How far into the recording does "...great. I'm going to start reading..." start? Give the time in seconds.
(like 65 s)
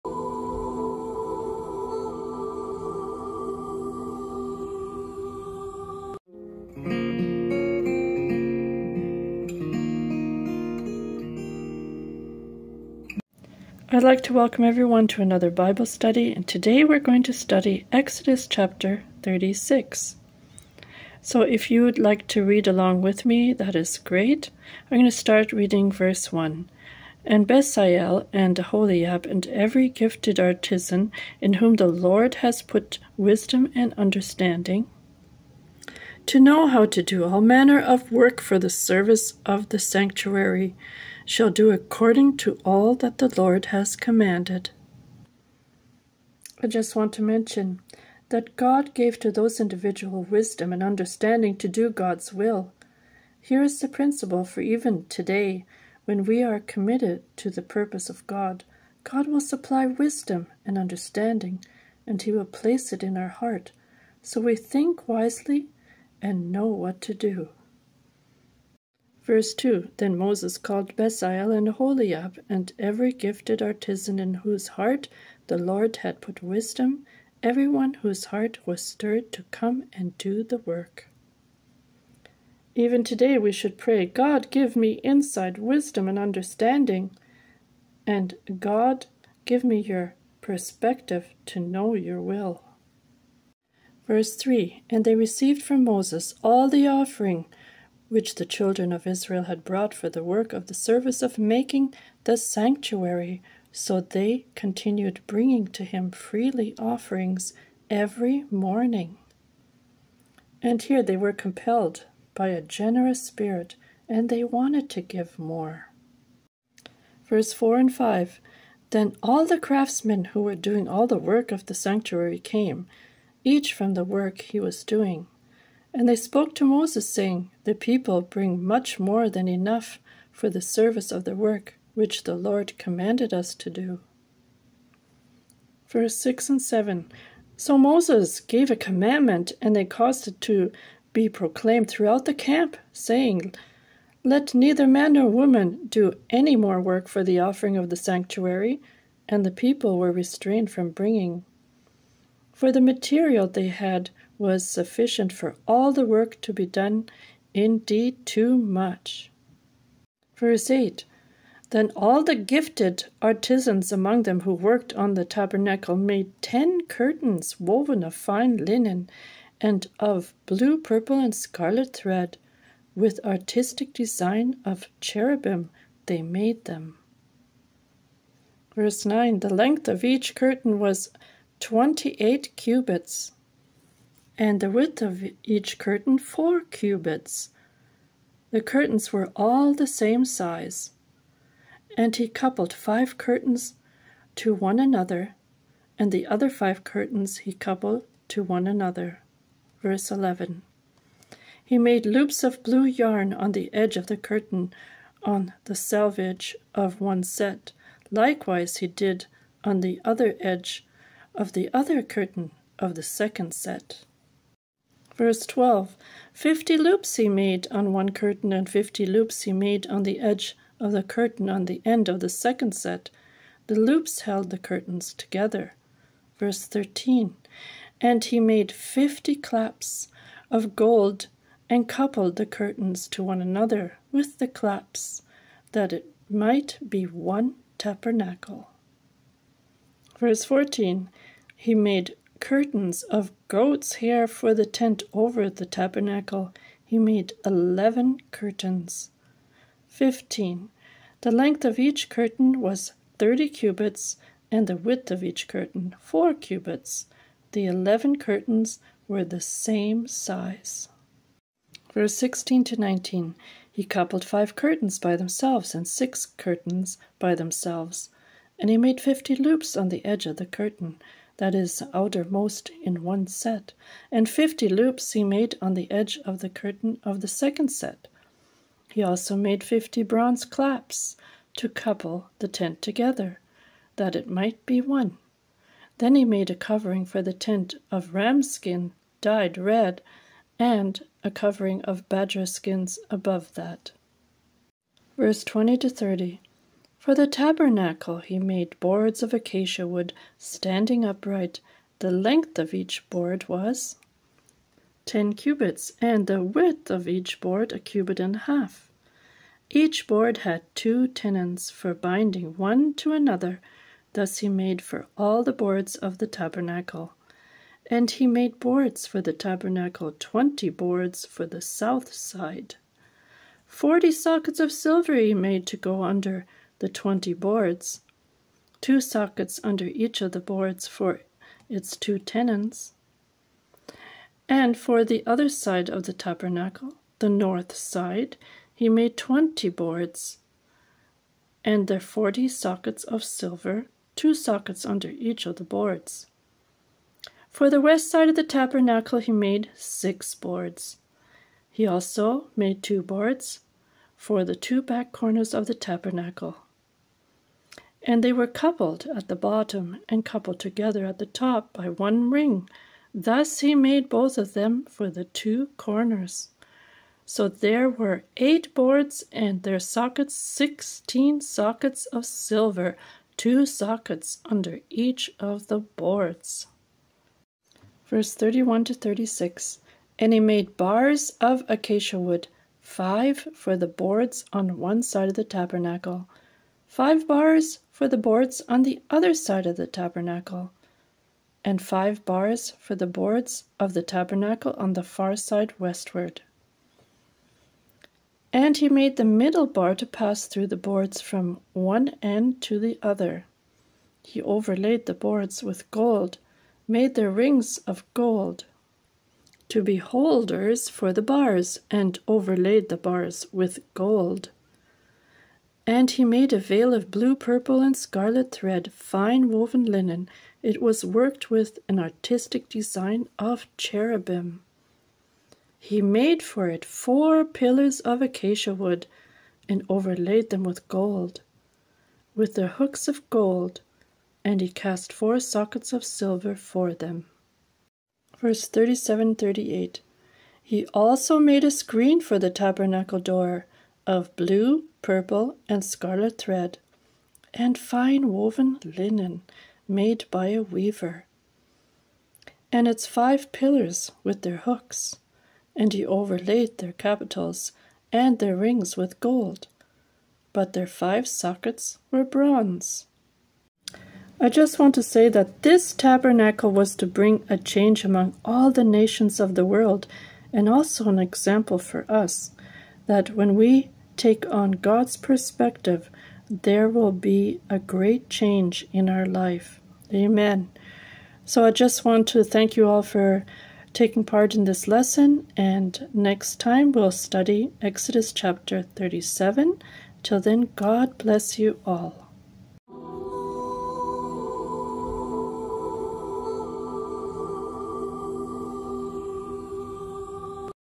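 23 s.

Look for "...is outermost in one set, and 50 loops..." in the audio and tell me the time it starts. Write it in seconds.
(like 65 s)
271 s.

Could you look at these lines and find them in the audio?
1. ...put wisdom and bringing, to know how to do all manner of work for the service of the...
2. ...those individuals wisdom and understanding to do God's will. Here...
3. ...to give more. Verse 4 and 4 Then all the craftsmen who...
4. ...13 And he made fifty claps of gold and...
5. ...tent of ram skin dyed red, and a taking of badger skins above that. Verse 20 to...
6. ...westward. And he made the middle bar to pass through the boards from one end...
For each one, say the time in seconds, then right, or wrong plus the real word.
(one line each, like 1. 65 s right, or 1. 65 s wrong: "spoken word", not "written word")
1. 32 s wrong: "understanding", not "bringing"
2. 49 s right
3. 114 s wrong: "5", not "4"
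4. 226 s right
5. 287 s wrong: "covering", not "taking"
6. 395 s right.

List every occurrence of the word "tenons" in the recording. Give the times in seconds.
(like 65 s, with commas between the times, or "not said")
311 s, 332 s.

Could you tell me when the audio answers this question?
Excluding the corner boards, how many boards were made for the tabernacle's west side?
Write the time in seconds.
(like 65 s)
349 s.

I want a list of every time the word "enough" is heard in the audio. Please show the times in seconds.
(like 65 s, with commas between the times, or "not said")
129 s.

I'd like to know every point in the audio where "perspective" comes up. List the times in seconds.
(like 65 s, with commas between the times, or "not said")
90 s, 475 s.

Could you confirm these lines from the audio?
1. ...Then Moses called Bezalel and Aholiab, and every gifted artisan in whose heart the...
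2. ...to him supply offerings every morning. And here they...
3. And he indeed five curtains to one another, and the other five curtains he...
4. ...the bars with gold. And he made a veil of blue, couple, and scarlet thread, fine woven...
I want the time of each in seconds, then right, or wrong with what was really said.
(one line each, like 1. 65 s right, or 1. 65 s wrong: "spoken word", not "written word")
1. 69 s right
2. 105 s wrong: "freely", not "supply"
3. 191 s wrong: "coupled", not "indeed"
4. 412 s wrong: "purple", not "couple".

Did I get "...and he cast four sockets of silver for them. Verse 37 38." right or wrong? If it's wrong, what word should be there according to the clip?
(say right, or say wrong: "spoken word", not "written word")
right.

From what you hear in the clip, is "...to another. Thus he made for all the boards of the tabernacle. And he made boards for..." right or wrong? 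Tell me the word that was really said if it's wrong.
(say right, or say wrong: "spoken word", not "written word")
right.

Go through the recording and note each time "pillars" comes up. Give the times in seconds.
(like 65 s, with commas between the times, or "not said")
427 s, 453 s.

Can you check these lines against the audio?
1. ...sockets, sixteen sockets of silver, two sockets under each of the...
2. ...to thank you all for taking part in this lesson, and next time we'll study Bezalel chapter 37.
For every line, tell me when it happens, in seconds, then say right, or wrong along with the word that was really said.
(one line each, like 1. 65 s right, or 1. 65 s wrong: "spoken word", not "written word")
1. 369 s right
2. 482 s wrong: "Exodus", not "Bezalel".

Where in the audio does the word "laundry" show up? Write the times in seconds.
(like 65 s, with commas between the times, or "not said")
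not said.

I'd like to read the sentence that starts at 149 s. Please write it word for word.
And the people were restrained from bringing.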